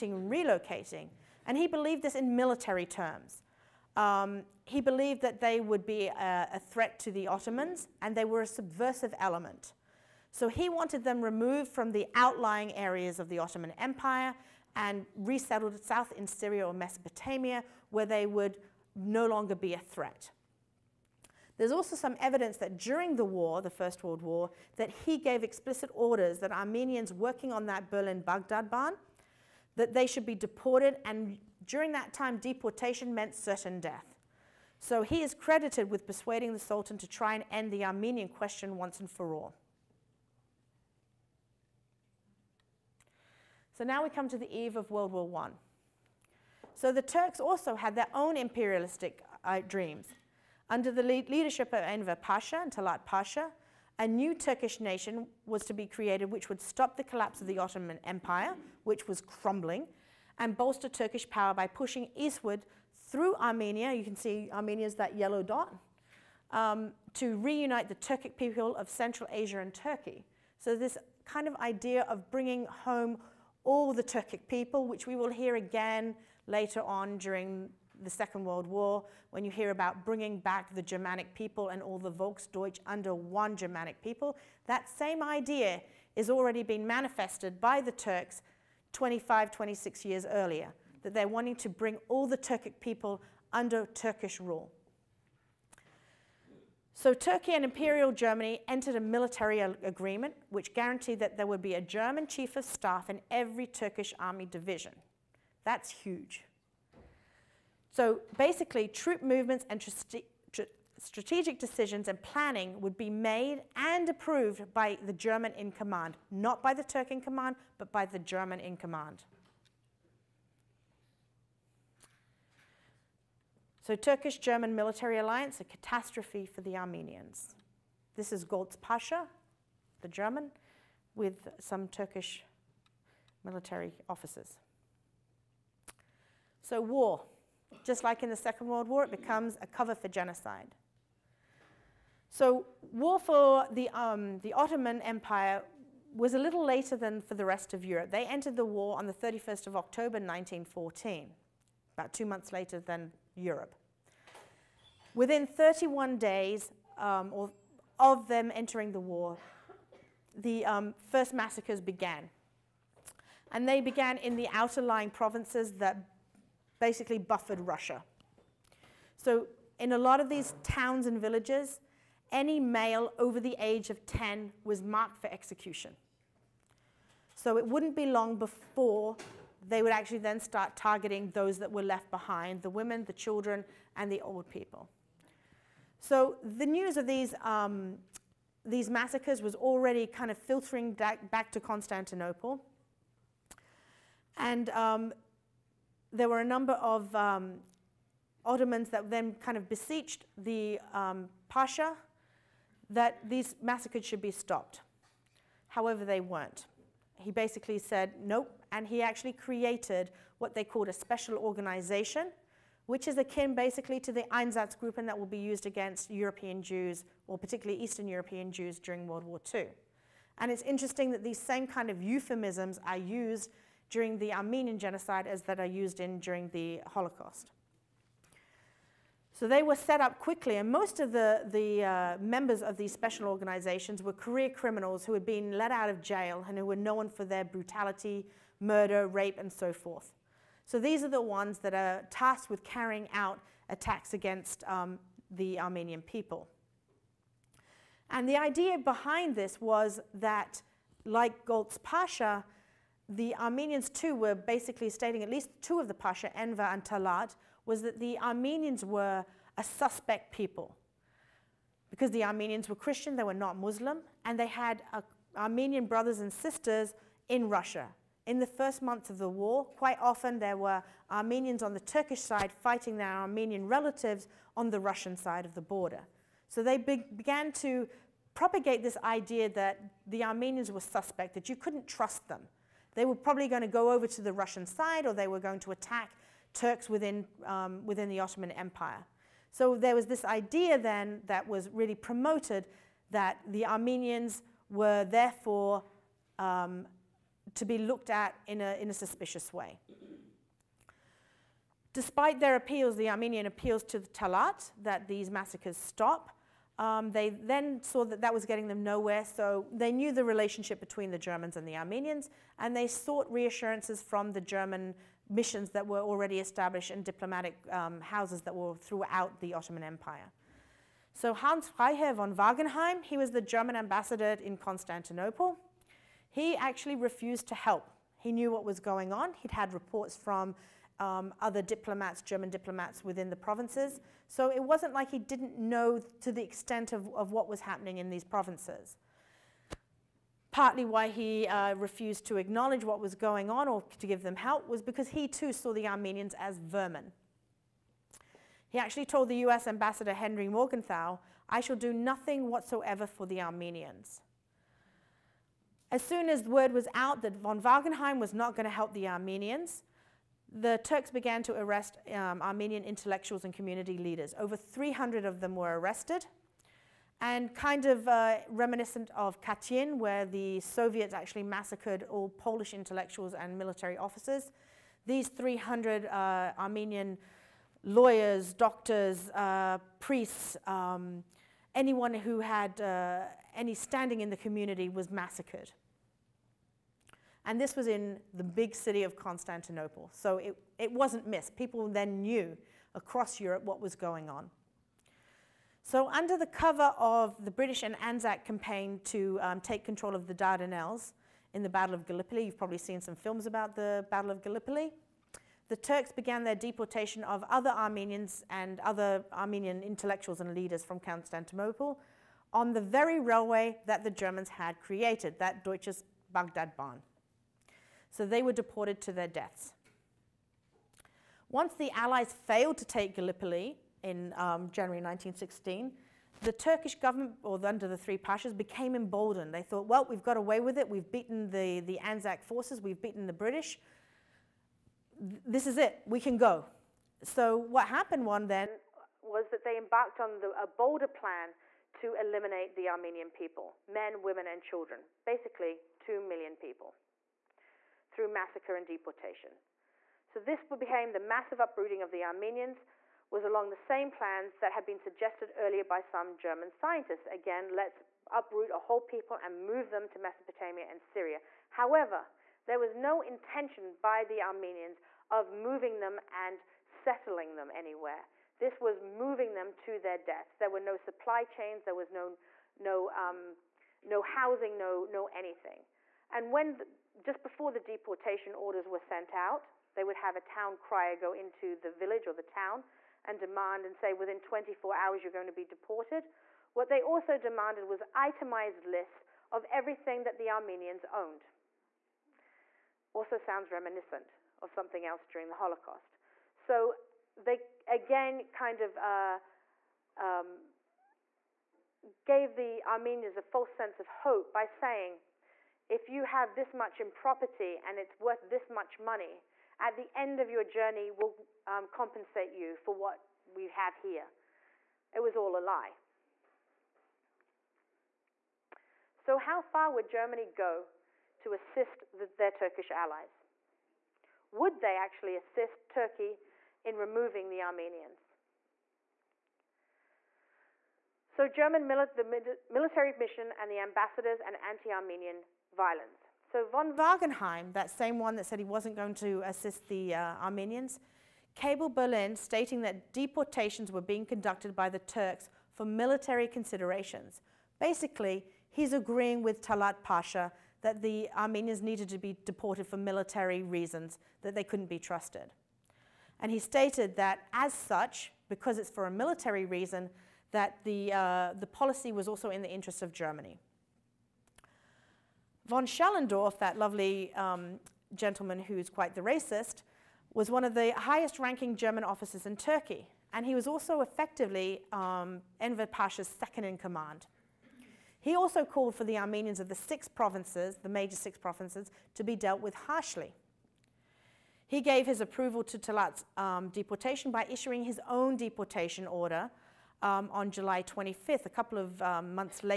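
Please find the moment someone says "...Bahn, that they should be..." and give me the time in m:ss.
0:28.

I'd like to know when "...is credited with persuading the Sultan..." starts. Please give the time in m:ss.
0:35.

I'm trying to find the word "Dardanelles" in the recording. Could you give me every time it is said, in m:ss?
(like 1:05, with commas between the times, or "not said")
6:40.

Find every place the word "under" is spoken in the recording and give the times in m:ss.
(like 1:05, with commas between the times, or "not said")
0:50, 1:22, 1:33, 6:36, 7:07.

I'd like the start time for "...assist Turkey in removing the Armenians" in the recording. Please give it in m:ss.
8:45.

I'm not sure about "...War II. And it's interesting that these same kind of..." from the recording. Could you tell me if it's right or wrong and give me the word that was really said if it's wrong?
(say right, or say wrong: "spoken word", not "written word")
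right.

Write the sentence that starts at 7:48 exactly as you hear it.
This was moving them to their deaths.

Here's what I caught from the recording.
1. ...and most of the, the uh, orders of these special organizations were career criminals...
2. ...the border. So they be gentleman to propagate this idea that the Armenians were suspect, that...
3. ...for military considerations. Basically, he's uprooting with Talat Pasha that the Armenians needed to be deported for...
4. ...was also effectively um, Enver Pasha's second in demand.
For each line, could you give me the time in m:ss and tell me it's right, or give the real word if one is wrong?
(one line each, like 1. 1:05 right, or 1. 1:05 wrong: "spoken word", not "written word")
1. 3:50 wrong: "members", not "orders"
2. 4:35 wrong: "began", not "gentleman"
3. 9:05 wrong: "agreeing", not "uprooting"
4. 9:33 wrong: "command", not "demand".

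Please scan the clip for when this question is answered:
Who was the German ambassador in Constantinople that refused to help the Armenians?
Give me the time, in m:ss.
5:21.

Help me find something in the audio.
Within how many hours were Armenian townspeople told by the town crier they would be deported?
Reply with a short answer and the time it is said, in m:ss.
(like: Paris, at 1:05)
24 hours, at 8:04.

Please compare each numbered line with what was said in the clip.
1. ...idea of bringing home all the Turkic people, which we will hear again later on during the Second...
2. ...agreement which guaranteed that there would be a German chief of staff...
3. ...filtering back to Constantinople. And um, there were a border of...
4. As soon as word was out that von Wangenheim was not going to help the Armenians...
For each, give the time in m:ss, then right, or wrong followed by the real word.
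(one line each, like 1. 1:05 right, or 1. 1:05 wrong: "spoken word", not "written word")
1. 1:11 right
2. 1:39 right
3. 3:10 wrong: "number", not "border"
4. 5:55 right.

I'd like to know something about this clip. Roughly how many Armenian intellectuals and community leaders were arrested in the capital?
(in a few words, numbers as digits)
300.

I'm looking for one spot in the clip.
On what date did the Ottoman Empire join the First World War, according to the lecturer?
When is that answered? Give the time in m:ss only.
2:29.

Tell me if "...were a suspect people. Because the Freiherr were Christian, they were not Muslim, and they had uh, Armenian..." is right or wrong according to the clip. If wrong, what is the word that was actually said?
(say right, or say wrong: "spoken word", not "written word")
wrong: "Armenians", not "Freiherr".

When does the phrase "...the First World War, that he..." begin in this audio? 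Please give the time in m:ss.
0:23.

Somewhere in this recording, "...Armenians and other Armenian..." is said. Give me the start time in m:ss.
6:47.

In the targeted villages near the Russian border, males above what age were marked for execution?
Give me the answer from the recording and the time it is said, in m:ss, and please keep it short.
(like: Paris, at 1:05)
10, at 2:53.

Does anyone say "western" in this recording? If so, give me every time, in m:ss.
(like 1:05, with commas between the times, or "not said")
not said.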